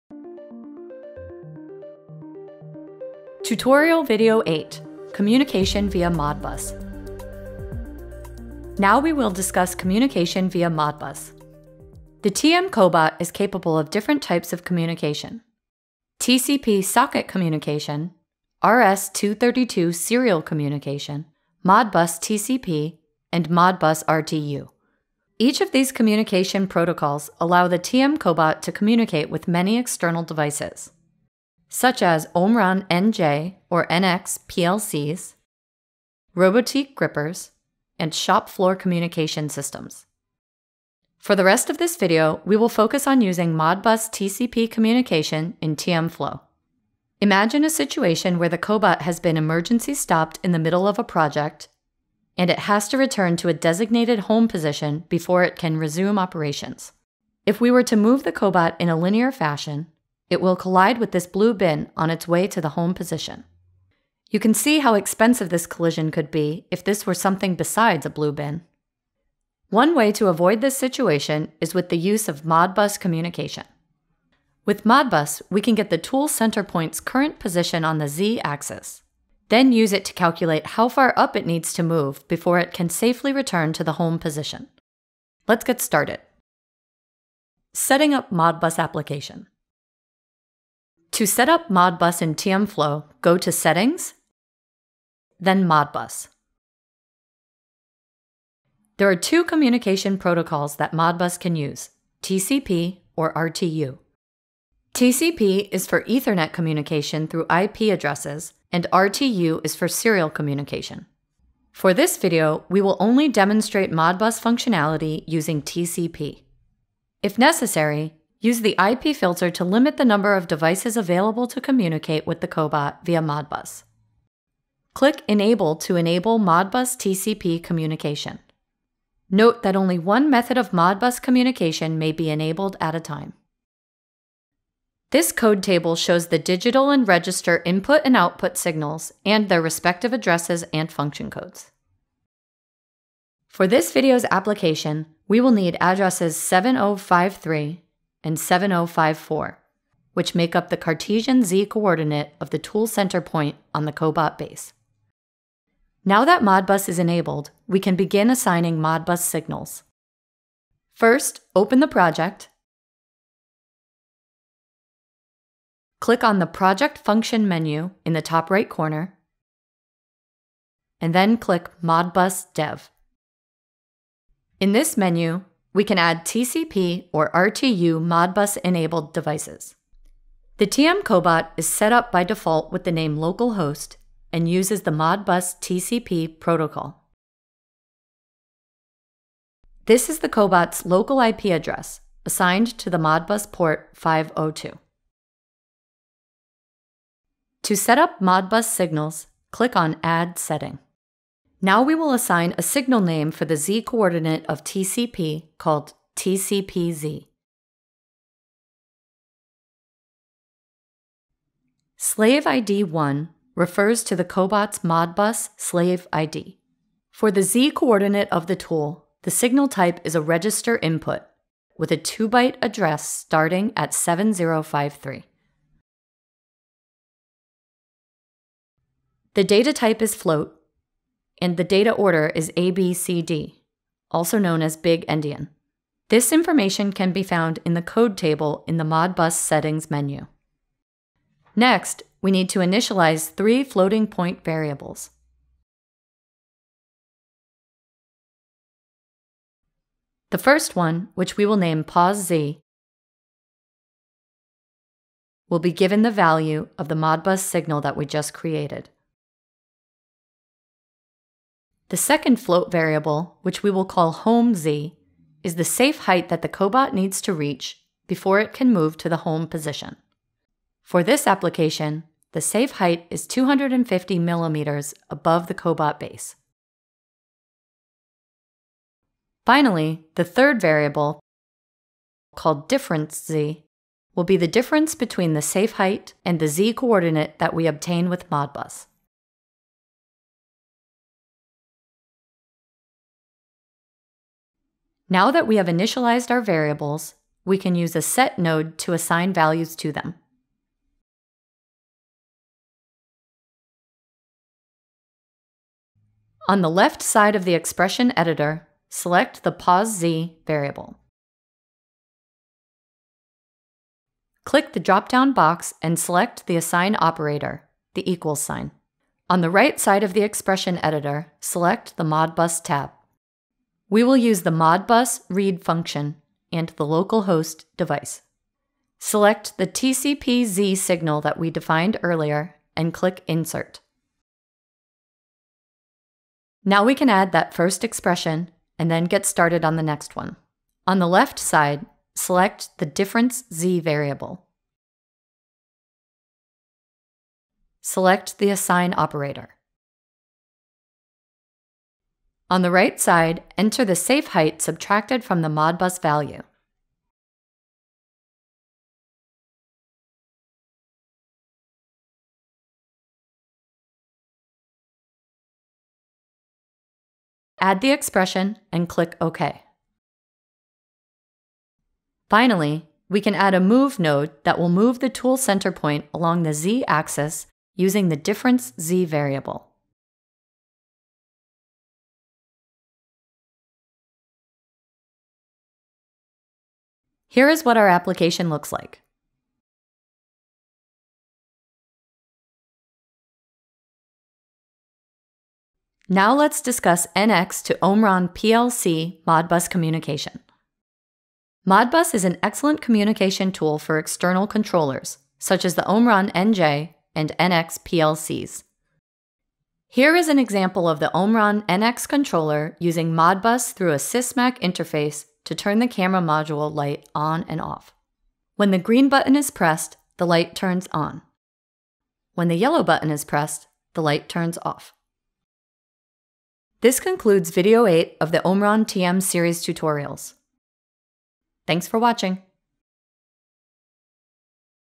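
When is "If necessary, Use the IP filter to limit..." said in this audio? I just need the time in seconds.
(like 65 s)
117 s.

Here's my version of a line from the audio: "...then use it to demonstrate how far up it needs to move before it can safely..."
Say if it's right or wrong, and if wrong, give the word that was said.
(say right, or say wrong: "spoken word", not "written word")
wrong: "calculate", not "demonstrate".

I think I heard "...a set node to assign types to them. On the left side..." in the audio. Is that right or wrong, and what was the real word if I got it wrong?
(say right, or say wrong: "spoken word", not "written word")
wrong: "values", not "types".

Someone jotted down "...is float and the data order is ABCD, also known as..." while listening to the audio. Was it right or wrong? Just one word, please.
right.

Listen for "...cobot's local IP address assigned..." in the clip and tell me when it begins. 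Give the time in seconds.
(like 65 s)
190 s.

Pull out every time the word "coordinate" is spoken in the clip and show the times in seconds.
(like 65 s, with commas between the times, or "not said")
151 s, 203 s, 217 s, 286 s.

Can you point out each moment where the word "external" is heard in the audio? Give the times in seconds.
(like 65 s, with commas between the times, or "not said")
29 s, 403 s.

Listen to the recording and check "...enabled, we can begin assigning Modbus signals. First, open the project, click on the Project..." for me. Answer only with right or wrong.
right.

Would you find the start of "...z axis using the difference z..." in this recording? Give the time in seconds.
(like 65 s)
376 s.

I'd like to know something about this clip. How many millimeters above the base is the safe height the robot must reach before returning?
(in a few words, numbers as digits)
250.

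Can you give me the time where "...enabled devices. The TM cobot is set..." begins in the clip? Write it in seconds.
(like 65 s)
178 s.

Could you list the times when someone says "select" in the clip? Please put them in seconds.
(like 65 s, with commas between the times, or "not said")
308 s, 315 s, 321 s, 328 s, 342 s, 347 s.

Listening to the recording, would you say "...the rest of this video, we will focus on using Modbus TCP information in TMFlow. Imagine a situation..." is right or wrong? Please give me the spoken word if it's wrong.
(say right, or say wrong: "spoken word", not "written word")
wrong: "communication", not "information".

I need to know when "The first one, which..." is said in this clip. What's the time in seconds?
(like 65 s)
250 s.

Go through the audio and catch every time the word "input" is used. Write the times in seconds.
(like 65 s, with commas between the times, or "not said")
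137 s, 220 s.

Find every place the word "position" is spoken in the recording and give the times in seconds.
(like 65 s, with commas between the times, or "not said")
54 s, 62 s, 77 s, 84 s, 269 s.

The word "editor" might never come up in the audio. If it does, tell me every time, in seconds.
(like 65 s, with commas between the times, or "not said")
308 s, 320 s.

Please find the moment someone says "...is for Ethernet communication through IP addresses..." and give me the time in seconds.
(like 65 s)
105 s.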